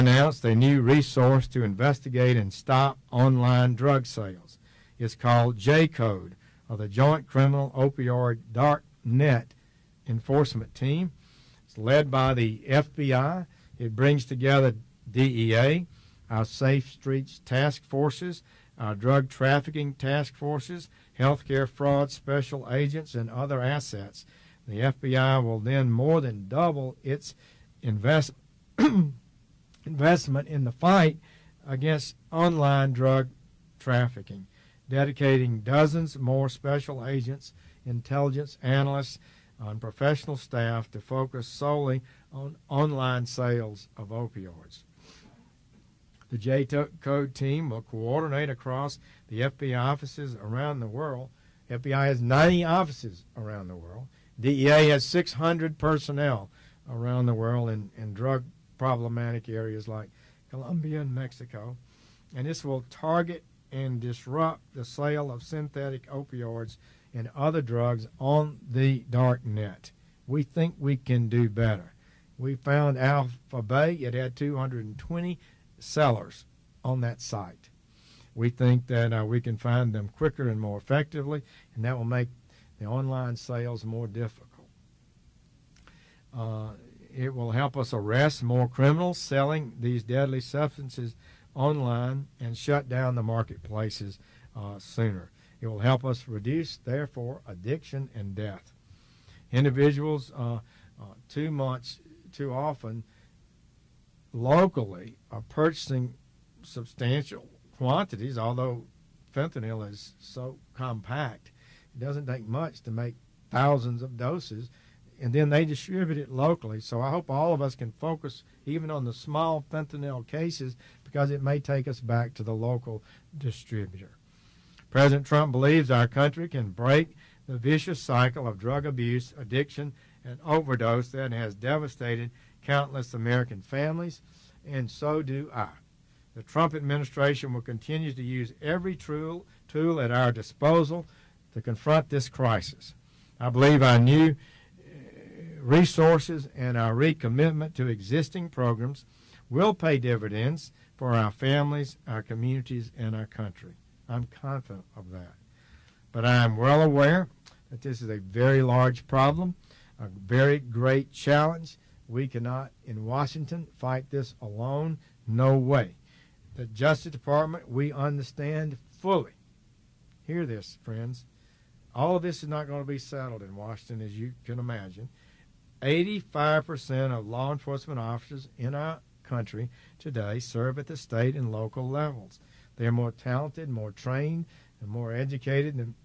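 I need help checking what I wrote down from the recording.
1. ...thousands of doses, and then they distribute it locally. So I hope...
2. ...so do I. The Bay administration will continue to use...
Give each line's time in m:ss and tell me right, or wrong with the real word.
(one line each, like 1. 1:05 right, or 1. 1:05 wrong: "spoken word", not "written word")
1. 1:53 right
2. 2:14 wrong: "Trump", not "Bay".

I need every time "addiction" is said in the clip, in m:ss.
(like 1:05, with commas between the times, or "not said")
1:37, 2:09.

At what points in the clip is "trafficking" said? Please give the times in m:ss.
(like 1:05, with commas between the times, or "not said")
0:19, 0:33.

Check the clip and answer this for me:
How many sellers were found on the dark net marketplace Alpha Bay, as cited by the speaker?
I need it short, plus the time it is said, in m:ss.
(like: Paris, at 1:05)
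220, at 1:14.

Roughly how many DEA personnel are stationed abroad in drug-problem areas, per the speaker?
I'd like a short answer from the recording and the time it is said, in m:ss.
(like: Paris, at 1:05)
600, at 0:55.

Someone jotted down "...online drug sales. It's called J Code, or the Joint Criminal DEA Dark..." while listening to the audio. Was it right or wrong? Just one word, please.
wrong.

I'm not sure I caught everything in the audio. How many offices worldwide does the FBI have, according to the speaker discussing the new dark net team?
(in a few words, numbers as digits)
90.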